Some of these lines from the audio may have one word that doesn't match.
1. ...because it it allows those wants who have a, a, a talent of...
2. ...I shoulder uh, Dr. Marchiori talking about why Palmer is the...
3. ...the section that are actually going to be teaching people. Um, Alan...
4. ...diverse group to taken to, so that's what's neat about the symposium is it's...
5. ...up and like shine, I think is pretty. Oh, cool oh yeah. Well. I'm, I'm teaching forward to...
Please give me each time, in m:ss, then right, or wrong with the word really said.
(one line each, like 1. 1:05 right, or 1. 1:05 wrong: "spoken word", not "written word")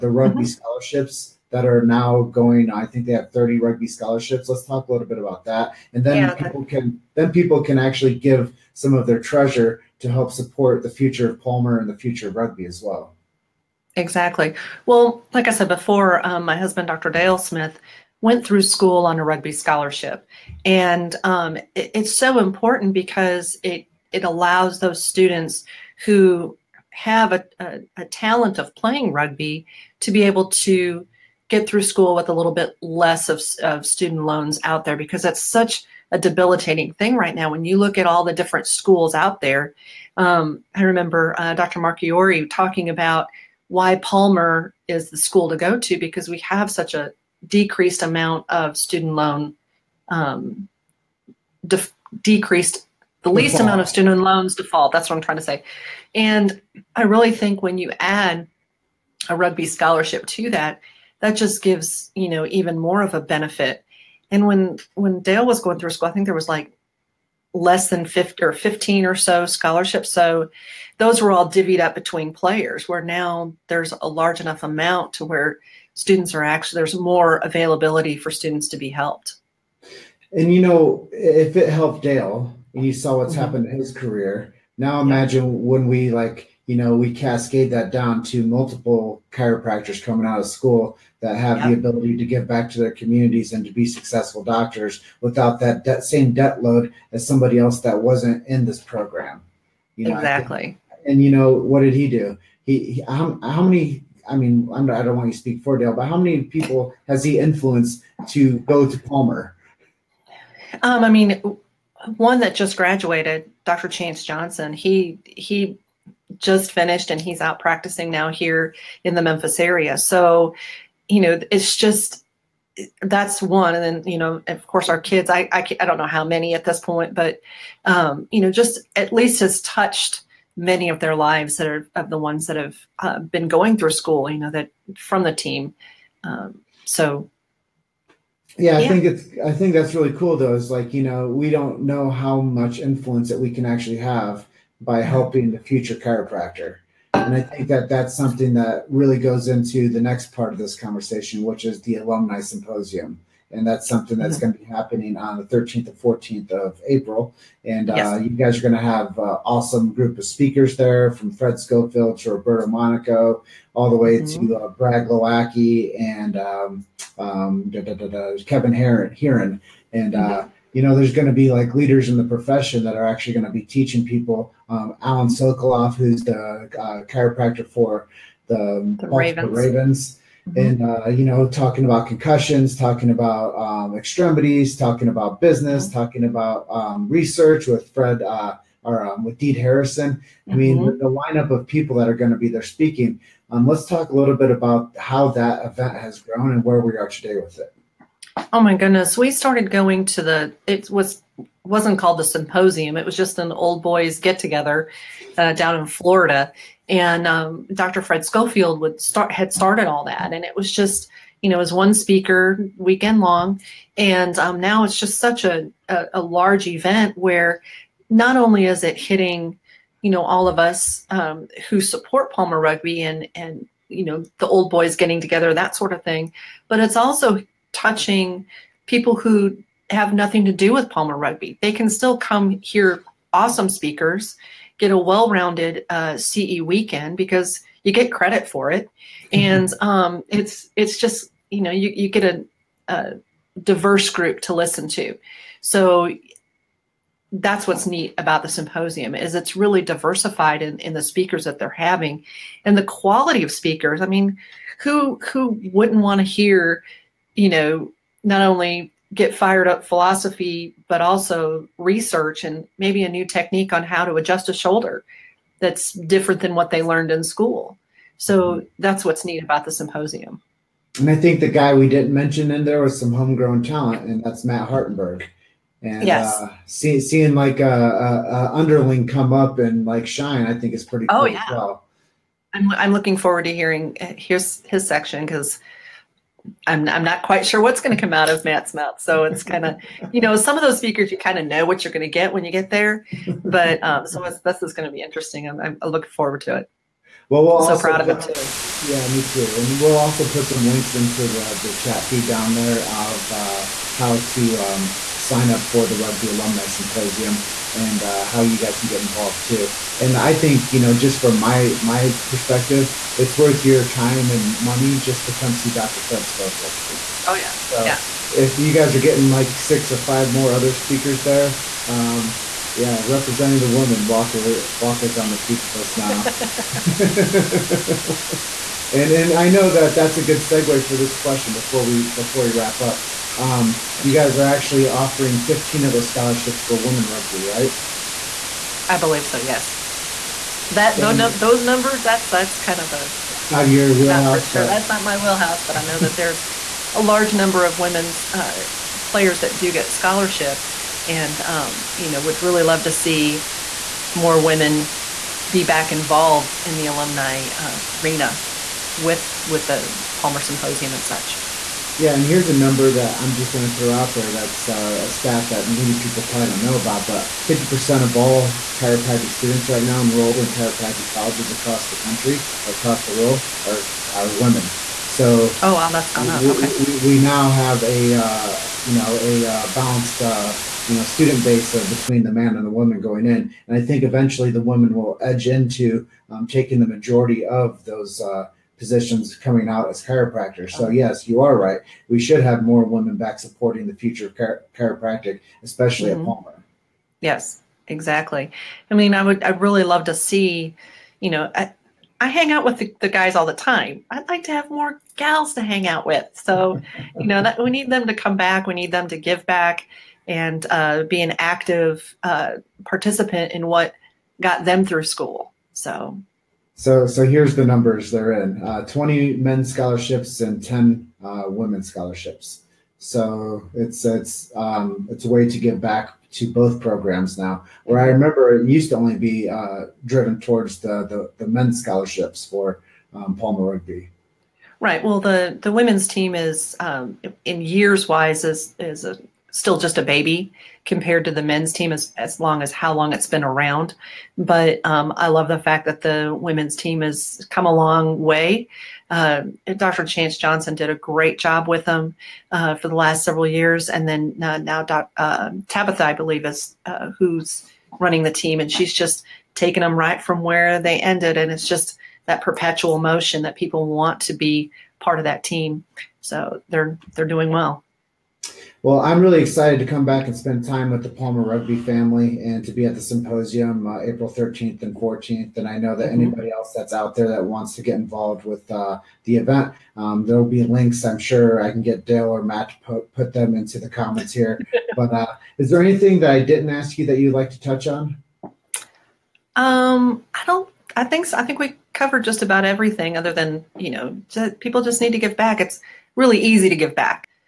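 1. 0:22 wrong: "students", not "wants"
2. 0:40 wrong: "remember", not "shoulder"
3. 2:52 wrong: "profession", not "section"
4. 4:03 wrong: "listen", not "taken"
5. 4:39 wrong: "looking", not "teaching".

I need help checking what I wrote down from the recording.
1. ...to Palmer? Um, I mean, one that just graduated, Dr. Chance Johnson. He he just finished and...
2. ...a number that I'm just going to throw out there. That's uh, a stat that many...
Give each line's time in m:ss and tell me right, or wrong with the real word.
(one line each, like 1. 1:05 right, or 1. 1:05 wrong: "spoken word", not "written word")
1. 1:48 right
2. 6:02 right.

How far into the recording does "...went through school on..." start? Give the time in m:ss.
0:18.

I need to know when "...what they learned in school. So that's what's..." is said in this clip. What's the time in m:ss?
4:26.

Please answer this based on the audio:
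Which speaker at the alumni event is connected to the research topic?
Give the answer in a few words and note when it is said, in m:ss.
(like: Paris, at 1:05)
Deed Harrison, at 3:09.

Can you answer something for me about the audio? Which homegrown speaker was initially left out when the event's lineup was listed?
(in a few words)
Matt Hartenberg.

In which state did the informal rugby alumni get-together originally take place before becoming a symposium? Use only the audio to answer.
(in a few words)
Florida.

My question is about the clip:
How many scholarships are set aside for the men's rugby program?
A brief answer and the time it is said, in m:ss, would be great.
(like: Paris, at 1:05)
20, at 6:58.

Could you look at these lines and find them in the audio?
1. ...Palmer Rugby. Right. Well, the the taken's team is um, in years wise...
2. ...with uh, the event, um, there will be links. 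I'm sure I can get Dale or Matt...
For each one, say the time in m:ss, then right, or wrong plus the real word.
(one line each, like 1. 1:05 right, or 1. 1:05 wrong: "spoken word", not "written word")
1. 7:13 wrong: "women", not "taken"
2. 7:58 right.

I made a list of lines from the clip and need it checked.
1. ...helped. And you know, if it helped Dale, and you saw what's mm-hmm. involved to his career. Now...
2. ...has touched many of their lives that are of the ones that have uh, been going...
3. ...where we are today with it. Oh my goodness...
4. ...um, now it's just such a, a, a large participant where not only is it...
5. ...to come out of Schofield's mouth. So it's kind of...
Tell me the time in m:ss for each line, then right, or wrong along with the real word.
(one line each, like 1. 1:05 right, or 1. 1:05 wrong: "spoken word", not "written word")
1. 1:18 wrong: "happened", not "involved"
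2. 2:09 right
3. 3:16 right
4. 3:34 wrong: "event", not "participant"
5. 4:47 wrong: "Matt", not "Schofield".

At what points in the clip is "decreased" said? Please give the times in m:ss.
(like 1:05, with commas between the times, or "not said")
0:47, 0:52.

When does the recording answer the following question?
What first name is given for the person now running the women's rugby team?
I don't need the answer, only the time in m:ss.
7:35.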